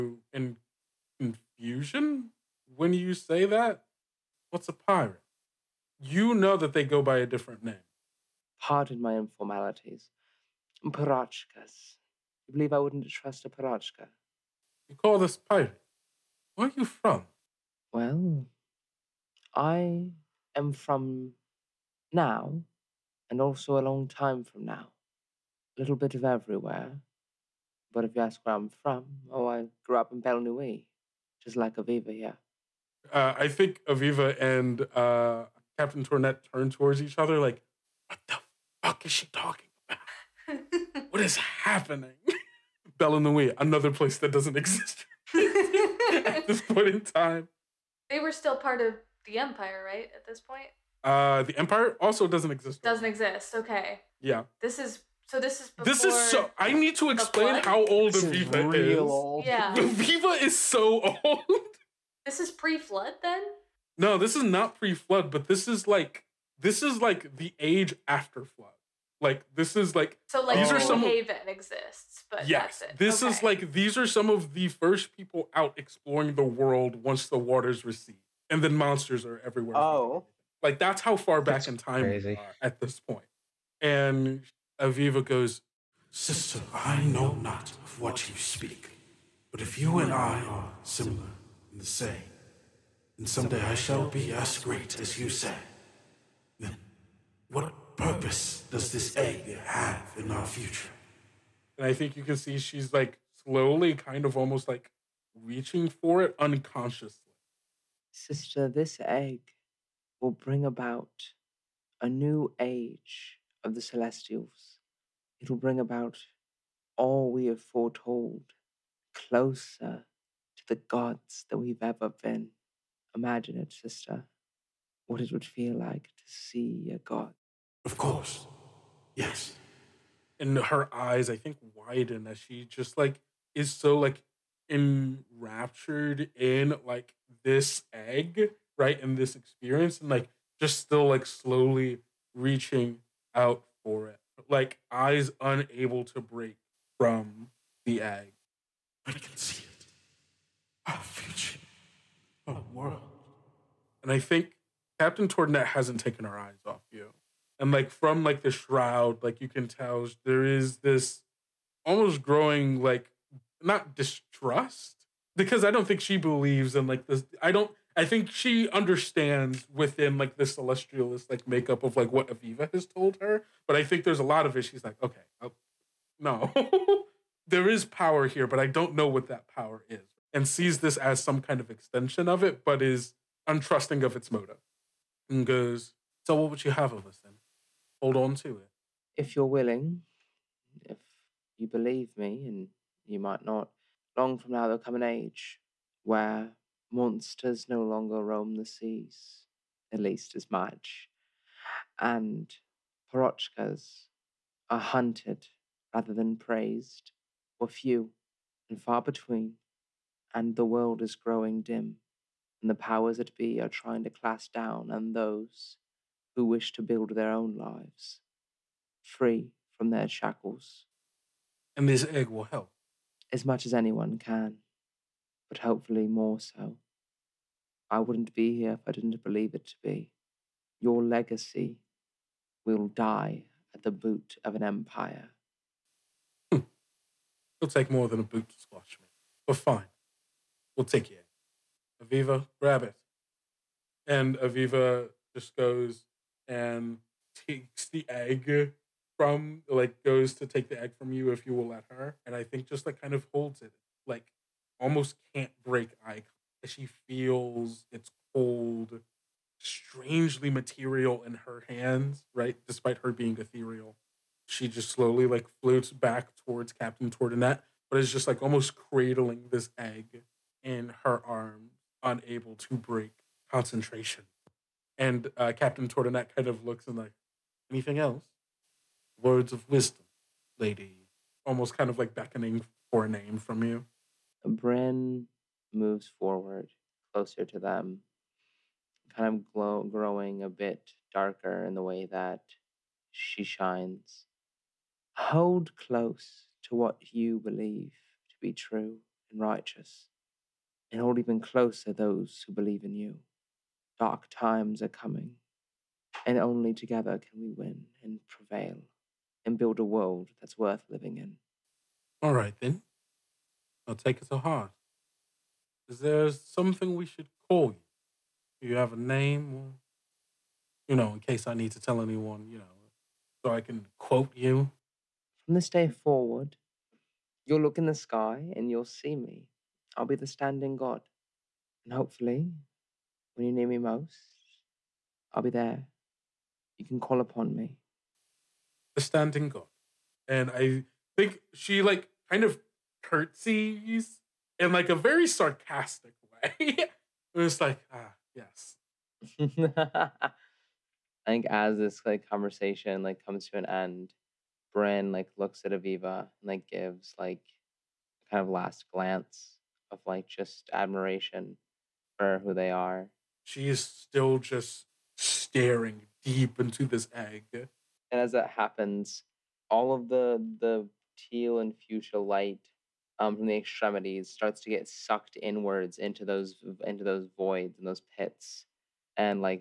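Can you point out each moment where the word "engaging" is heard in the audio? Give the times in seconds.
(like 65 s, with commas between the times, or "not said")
not said.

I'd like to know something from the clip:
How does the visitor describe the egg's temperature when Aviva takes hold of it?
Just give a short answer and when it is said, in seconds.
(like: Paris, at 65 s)
Cold, at 258 s.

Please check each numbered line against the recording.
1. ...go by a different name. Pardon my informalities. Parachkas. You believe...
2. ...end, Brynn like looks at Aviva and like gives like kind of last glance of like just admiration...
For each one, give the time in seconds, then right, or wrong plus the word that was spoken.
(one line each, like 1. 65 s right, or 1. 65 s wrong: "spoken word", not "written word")
1. 6 s right
2. 353 s right.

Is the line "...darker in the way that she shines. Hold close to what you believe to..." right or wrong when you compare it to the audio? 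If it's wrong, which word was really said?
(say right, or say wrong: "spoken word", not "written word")
right.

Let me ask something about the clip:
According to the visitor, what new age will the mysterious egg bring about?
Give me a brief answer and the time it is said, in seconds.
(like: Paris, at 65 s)
A new age of the celestials, at 112 s.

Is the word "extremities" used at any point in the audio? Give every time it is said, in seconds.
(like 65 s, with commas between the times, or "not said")
373 s.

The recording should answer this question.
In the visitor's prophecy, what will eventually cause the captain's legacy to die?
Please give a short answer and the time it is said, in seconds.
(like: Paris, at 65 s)
The boot of an empire, at 233 s.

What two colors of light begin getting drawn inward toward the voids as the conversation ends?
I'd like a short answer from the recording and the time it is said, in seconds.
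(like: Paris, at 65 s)
Teal and fuchsia, at 371 s.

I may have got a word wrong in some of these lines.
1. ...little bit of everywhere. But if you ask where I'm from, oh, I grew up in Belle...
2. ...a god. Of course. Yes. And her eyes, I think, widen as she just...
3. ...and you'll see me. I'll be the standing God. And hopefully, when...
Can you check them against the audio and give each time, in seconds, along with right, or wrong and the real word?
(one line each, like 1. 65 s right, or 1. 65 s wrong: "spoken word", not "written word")
1. 25 s right
2. 126 s right
3. 328 s right.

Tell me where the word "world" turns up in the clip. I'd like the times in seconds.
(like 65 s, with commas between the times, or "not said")
76 s, 152 s, 210 s, 309 s.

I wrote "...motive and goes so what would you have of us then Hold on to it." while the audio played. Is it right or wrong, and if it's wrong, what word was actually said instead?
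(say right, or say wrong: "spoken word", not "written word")
right.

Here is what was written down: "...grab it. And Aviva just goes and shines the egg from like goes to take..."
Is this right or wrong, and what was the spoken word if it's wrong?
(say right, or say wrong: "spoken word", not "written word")
wrong: "takes", not "shines".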